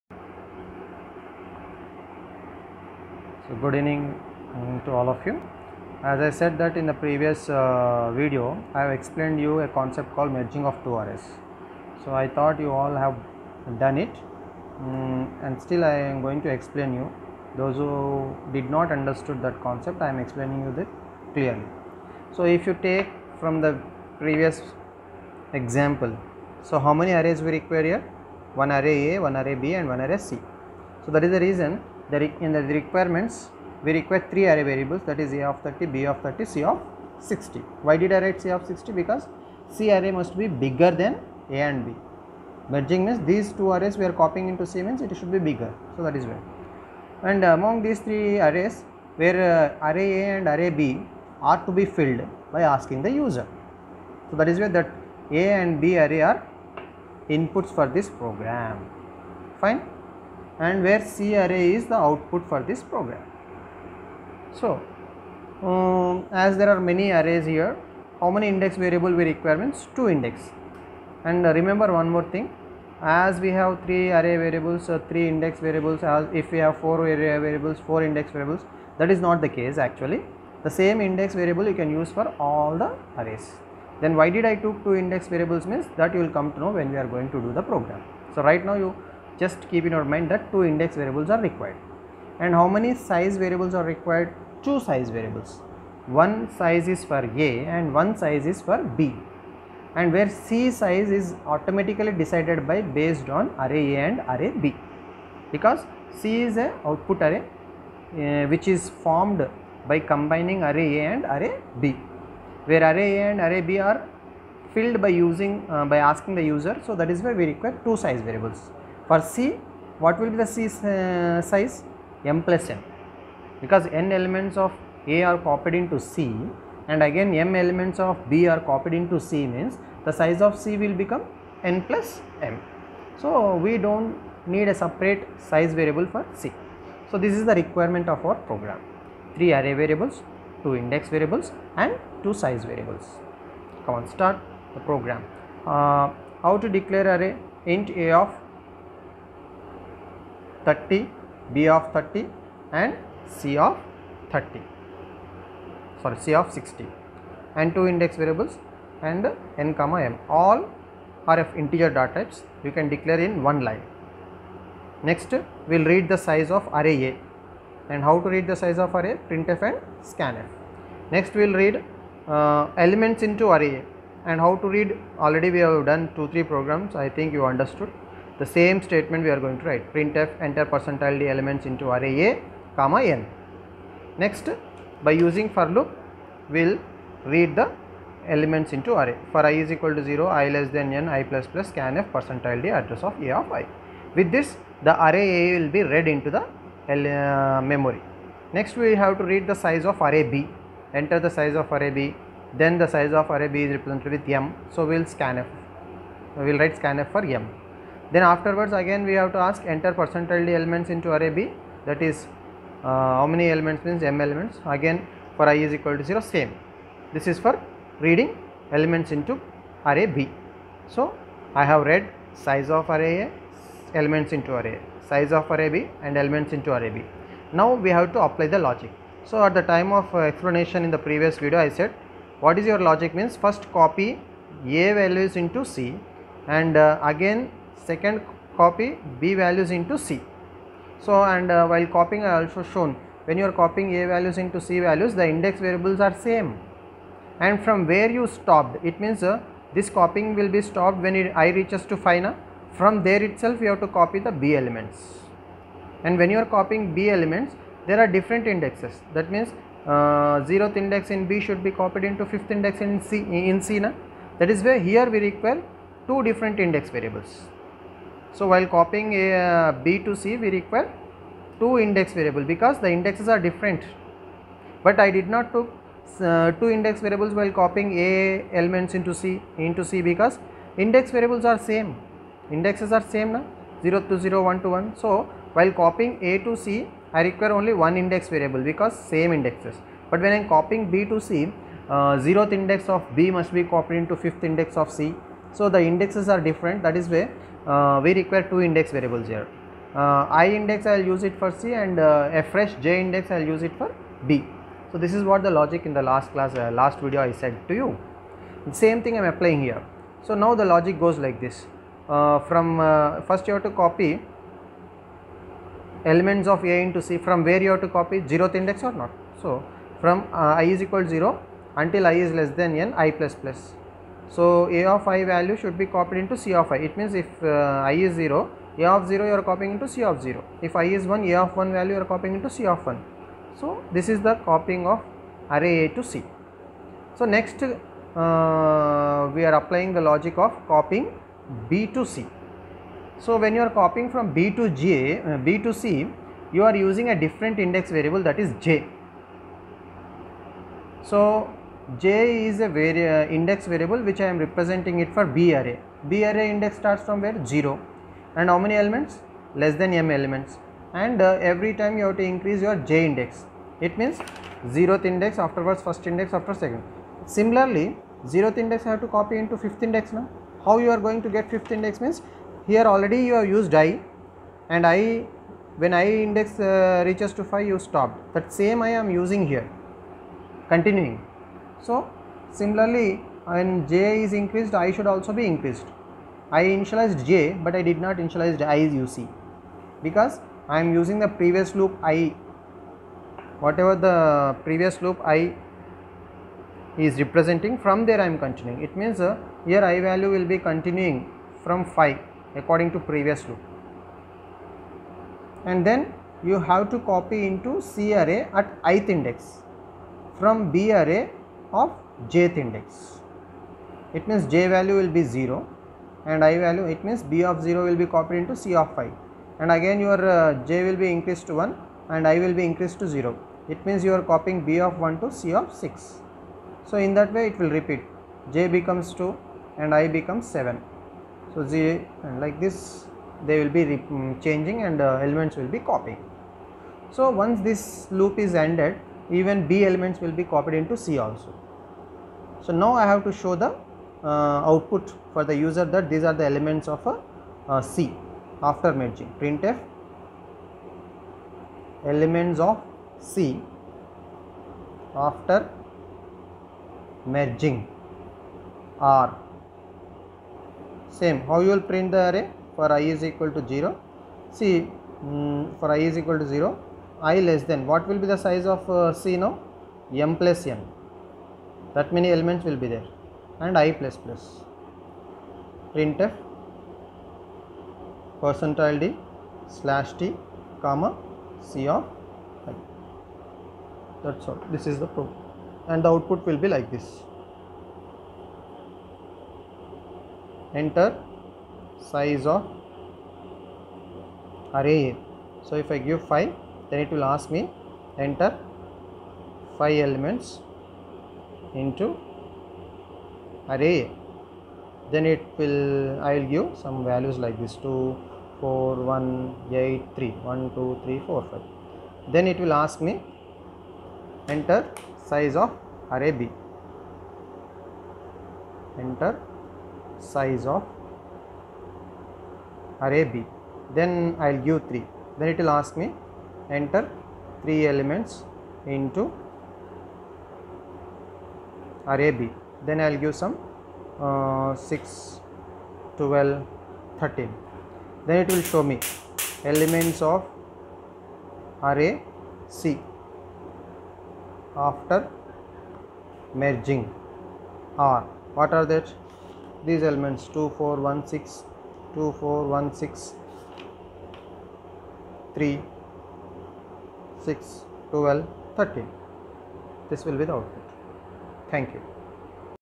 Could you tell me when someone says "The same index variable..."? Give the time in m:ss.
1:20.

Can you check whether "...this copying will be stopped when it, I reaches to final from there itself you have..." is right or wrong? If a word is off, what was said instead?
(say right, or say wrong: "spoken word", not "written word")
right.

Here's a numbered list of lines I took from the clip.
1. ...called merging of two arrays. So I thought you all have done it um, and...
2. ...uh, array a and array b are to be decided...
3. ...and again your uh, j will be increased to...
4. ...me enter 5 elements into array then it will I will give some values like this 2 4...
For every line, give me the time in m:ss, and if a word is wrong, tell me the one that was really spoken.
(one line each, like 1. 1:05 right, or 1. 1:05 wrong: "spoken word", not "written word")
1. 0:10 right
2. 0:49 wrong: "filled", not "decided"
3. 6:59 right
4. 8:17 right.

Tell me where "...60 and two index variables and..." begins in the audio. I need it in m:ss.
2:36.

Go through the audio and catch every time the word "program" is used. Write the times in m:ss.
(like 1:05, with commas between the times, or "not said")
0:58, 1:02, 1:27, 2:18, 2:24, 2:56, 8:05.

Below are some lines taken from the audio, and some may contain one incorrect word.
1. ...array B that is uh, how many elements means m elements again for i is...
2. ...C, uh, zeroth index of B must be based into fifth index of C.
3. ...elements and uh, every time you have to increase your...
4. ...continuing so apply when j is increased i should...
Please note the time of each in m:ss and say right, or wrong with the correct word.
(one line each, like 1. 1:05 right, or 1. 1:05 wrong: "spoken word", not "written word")
1. 3:31 right
2. 4:51 wrong: "copied", not "based"
3. 6:00 right
4. 6:20 wrong: "similarly", not "apply".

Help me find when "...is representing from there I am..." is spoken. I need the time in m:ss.
6:36.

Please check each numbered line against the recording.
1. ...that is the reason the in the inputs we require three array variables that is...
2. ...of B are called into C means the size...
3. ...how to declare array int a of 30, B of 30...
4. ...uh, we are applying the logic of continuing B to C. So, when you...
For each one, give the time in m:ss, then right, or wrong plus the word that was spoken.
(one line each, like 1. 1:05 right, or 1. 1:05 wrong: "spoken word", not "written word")
1. 0:31 wrong: "requirements", not "inputs"
2. 2:08 wrong: "copied", not "called"
3. 2:26 right
4. 5:37 wrong: "copying", not "continuing".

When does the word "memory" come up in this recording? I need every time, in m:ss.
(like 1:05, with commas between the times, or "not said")
3:17.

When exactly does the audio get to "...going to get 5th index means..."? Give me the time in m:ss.
6:10.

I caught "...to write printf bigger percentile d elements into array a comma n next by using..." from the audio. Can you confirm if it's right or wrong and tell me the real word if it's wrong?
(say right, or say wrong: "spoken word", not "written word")
wrong: "enter", not "bigger".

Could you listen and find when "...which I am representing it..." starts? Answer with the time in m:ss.
5:54.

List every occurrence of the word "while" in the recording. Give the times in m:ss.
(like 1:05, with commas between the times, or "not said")
4:01, 4:28, 4:37, 4:45.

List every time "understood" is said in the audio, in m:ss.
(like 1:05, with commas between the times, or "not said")
0:18, 2:57.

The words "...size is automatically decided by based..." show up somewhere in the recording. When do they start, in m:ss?
1:40.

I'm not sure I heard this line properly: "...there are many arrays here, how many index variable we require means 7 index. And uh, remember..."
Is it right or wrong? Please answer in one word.
wrong.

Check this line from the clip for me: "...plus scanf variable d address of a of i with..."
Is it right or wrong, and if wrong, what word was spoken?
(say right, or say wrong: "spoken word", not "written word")
wrong: "percentile", not "variable".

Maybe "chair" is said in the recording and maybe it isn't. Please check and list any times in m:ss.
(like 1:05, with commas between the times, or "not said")
not said.